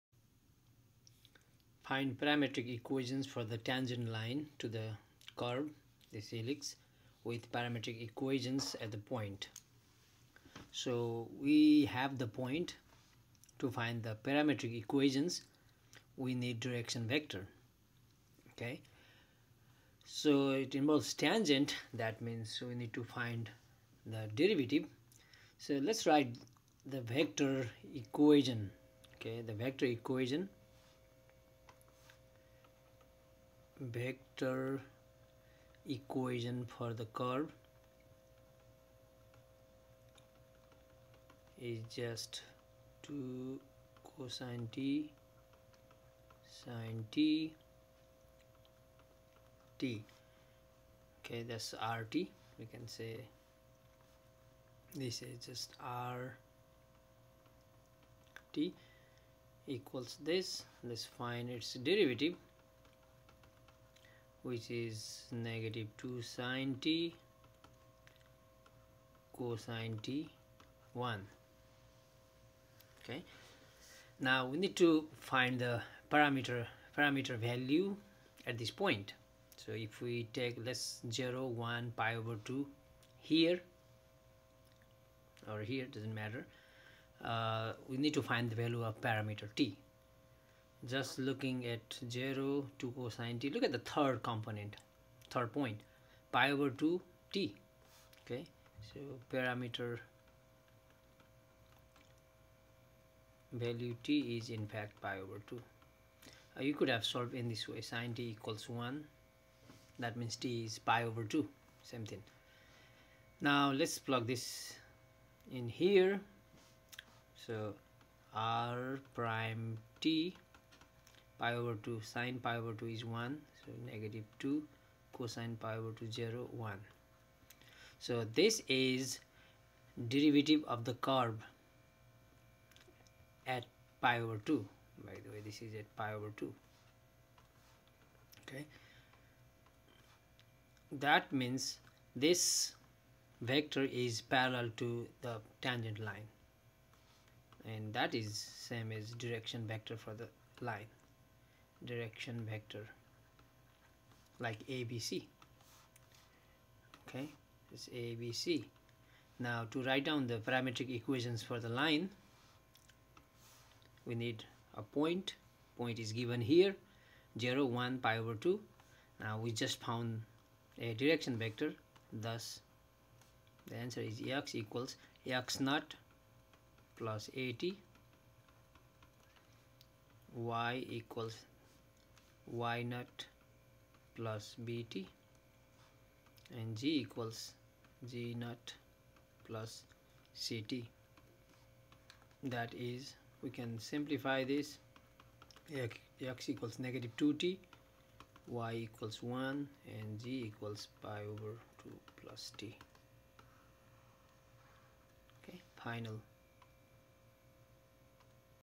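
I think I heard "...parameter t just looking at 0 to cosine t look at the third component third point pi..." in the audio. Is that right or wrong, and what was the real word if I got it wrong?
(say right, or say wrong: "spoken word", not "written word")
right.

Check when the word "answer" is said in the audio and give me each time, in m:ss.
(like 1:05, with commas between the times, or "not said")
2:53.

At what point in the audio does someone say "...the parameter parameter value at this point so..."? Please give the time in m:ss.
1:15.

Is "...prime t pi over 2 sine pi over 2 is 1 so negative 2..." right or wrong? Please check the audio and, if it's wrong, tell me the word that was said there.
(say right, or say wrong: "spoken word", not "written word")
right.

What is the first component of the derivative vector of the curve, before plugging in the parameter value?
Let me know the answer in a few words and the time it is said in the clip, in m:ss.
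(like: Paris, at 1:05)
-2 sin t, at 1:05.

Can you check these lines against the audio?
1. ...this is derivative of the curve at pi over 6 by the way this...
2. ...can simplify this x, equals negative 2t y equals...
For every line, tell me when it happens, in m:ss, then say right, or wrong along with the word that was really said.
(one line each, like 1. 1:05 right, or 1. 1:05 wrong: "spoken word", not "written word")
1. 2:08 wrong: "2", not "6"
2. 3:13 right.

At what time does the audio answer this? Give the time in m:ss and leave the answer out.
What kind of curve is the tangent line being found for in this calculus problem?
0:06.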